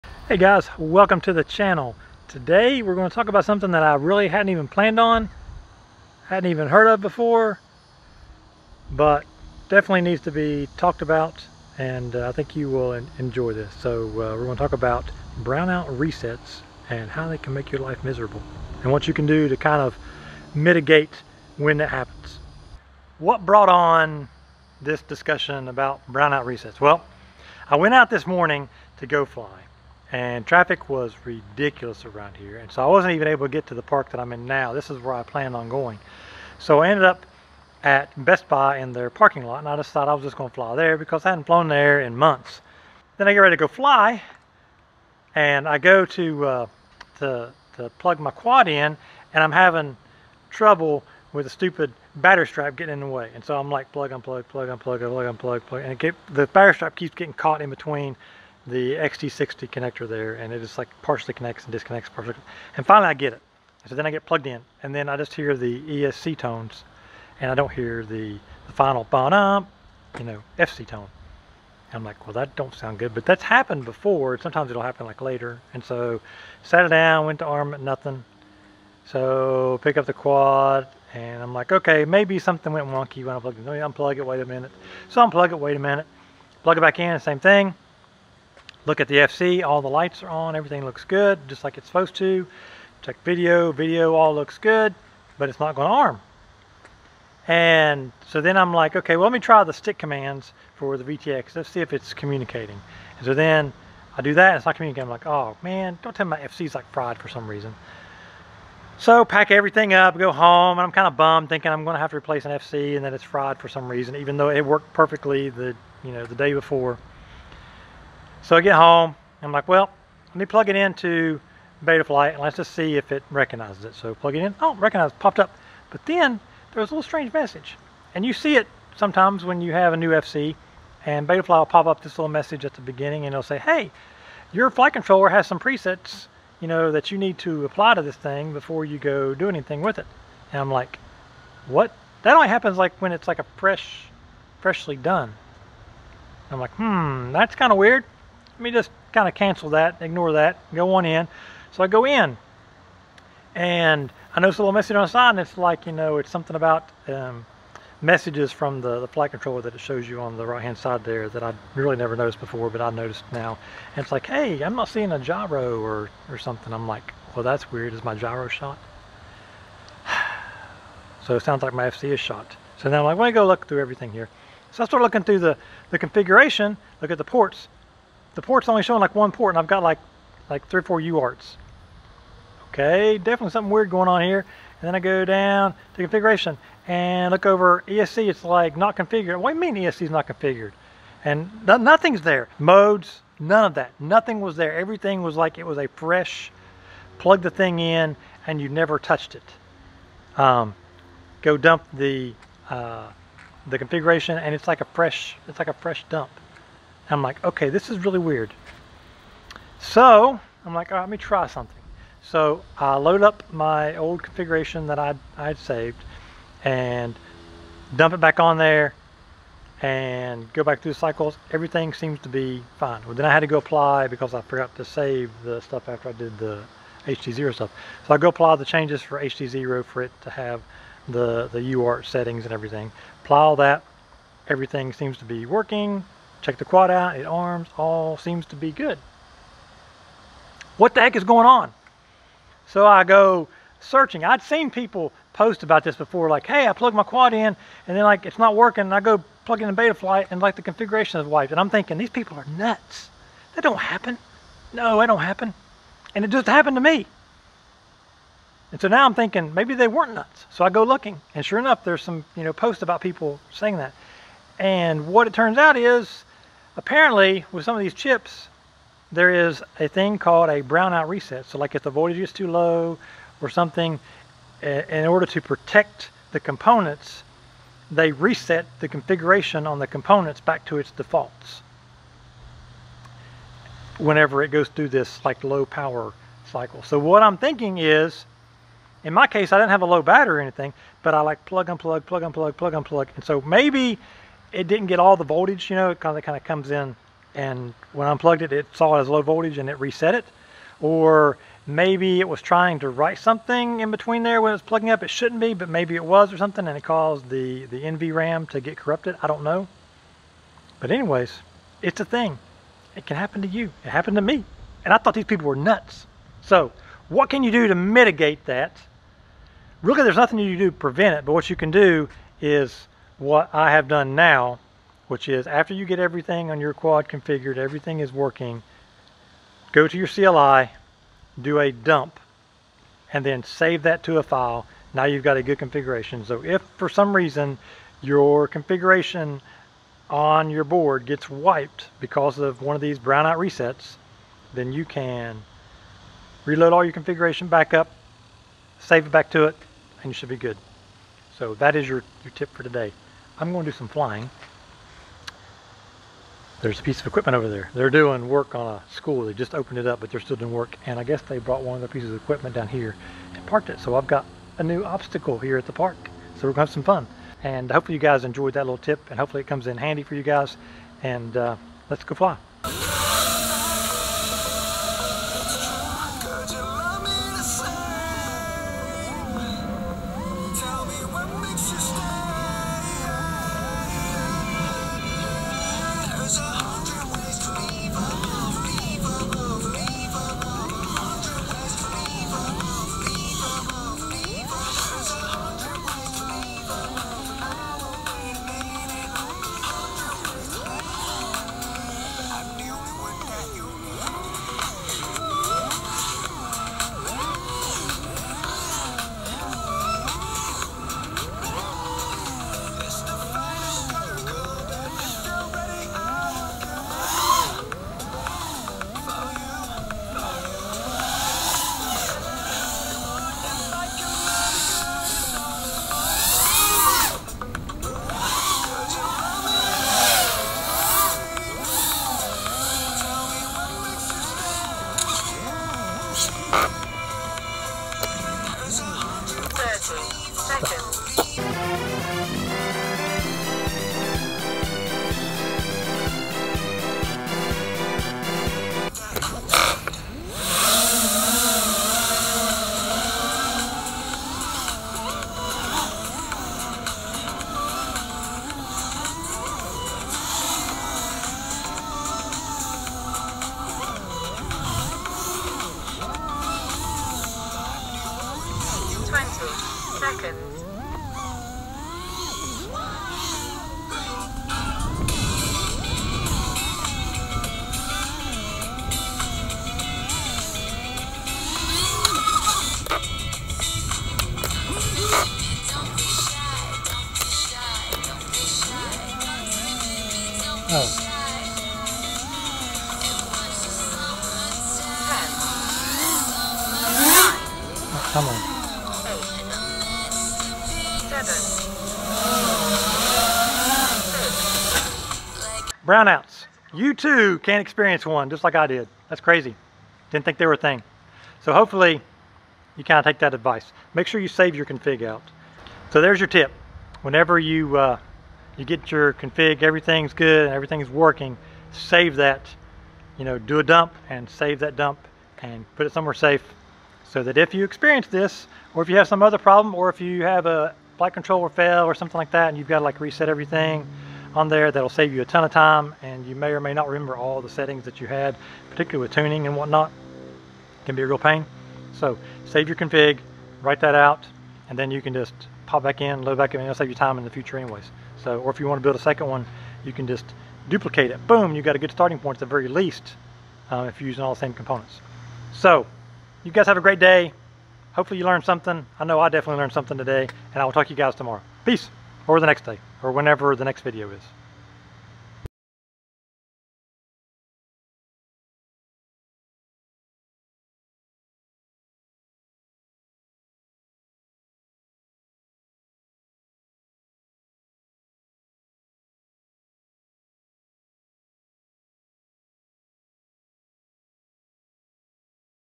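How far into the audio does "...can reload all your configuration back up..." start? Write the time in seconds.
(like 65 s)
344 s.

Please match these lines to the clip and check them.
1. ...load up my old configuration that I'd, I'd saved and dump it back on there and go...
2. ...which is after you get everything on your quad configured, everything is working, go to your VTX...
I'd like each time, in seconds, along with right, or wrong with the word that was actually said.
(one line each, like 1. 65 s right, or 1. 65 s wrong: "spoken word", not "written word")
1. 212 s right
2. 325 s wrong: "CLI", not "VTX".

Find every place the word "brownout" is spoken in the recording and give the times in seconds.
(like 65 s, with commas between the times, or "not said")
15 s, 26 s, 270 s, 342 s, 505 s.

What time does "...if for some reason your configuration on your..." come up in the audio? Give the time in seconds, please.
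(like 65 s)
336 s.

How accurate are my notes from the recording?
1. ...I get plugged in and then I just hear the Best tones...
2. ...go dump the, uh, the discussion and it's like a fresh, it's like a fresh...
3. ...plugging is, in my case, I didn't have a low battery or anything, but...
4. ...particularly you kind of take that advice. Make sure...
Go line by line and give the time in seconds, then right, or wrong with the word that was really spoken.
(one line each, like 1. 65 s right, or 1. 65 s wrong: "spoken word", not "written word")
1. 64 s wrong: "ESC", not "Best"
2. 201 s wrong: "configuration", not "discussion"
3. 287 s wrong: "thinking", not "plugging"
4. 511 s wrong: "hopefully", not "particularly".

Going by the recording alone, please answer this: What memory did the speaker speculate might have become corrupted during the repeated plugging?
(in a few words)
NVRAM.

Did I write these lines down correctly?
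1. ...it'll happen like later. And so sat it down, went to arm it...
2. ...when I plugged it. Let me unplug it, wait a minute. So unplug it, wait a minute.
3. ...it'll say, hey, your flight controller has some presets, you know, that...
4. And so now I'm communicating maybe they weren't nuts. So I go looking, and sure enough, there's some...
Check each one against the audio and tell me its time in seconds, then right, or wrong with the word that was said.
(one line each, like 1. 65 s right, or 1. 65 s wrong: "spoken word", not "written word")
1. 74 s right
2. 83 s right
3. 133 s right
4. 258 s wrong: "thinking", not "communicating".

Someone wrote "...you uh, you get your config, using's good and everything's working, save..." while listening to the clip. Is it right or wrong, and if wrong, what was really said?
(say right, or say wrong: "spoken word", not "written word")
wrong: "everything", not "using".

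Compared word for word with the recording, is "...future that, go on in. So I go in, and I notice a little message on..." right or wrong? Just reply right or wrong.
wrong.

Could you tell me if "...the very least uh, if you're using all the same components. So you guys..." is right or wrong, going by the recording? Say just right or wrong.
right.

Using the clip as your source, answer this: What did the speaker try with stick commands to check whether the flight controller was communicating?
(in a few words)
VTX.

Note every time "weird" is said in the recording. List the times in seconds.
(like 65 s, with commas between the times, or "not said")
147 s, 167 s, 183 s, 208 s.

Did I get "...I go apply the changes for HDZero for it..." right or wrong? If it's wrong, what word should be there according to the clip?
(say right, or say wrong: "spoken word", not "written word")
right.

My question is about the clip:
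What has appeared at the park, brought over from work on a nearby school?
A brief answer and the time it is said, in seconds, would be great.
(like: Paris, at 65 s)
piece of equipment, at 356 s.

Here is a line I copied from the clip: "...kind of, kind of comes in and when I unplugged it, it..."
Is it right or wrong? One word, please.
right.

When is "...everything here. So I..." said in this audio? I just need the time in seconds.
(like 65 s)
173 s.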